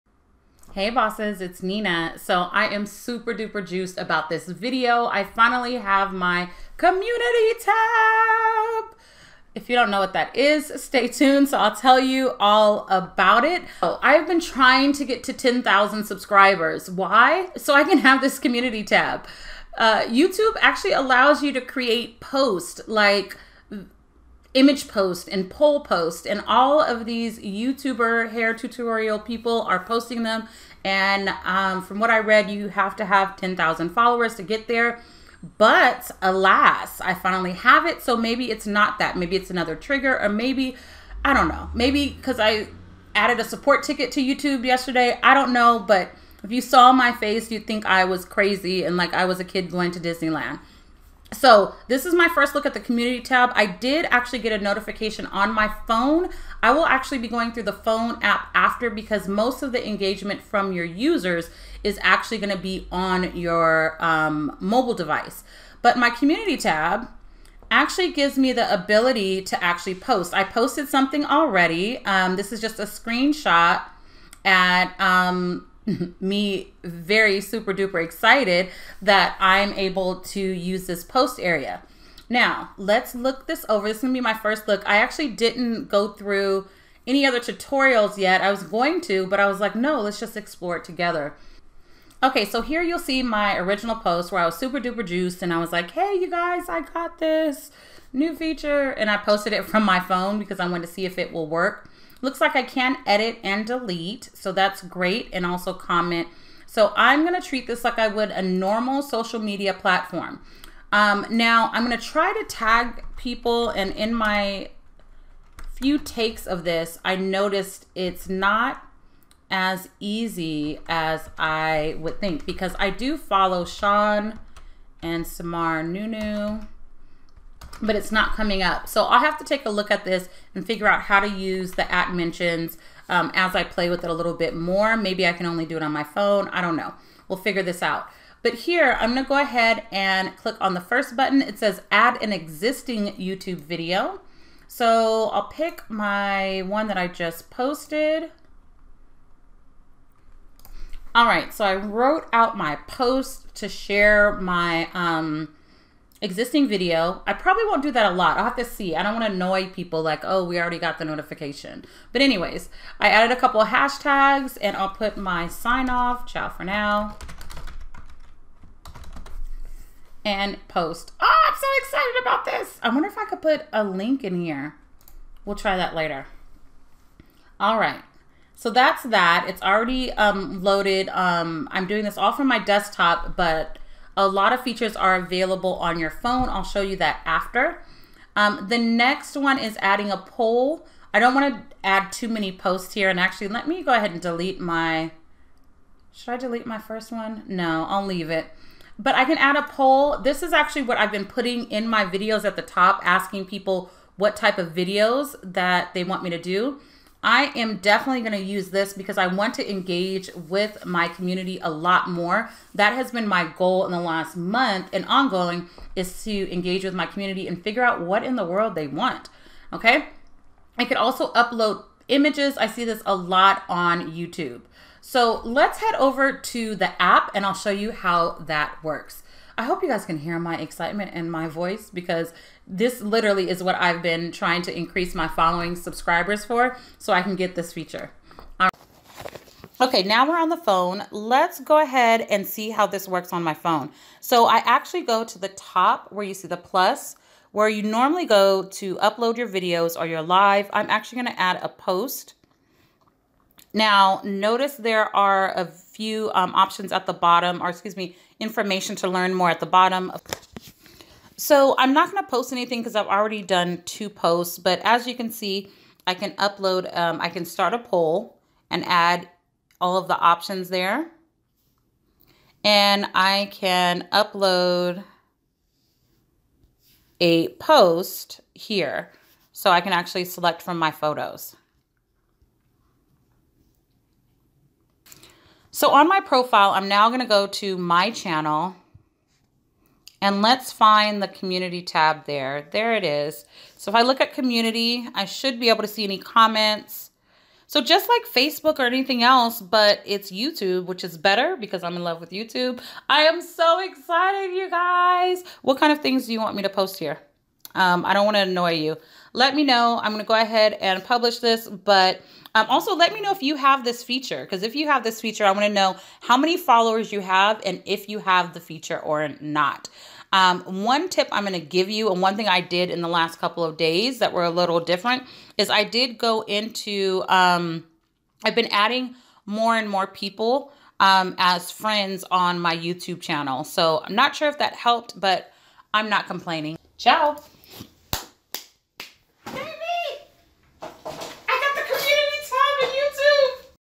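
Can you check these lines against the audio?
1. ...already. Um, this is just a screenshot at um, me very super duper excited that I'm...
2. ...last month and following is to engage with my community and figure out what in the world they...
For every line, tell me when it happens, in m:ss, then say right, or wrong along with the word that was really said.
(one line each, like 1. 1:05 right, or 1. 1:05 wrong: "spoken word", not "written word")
1. 1:11 right
2. 3:33 wrong: "ongoing", not "following".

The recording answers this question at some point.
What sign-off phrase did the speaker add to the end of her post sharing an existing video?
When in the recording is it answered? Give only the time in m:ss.
2:46.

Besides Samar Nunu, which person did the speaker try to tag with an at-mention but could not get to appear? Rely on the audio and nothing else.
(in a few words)
Sean.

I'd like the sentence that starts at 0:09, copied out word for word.
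If you don't know what that is, stay tuned.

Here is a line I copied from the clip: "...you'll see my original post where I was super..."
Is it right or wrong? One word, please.
right.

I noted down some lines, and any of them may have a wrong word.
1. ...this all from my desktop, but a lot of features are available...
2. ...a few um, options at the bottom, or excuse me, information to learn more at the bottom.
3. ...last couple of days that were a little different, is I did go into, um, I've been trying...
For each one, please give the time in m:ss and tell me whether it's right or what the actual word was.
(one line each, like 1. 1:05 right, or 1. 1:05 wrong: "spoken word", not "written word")
1. 3:02 right
2. 4:15 right
3. 5:23 wrong: "adding", not "trying".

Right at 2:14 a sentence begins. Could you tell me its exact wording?
Maybe I can only do it on my phone.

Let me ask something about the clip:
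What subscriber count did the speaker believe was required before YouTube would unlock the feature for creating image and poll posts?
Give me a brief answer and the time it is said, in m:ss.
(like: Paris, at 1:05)
10,000, at 0:15.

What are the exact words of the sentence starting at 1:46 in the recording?
So I'm gonna treat this like I would a normal social media platform.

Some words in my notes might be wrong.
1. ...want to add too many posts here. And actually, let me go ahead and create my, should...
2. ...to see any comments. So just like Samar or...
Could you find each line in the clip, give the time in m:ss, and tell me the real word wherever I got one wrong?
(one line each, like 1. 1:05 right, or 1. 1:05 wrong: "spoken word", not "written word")
1. 3:11 wrong: "delete", not "create"
2. 4:55 wrong: "Facebook", not "Samar".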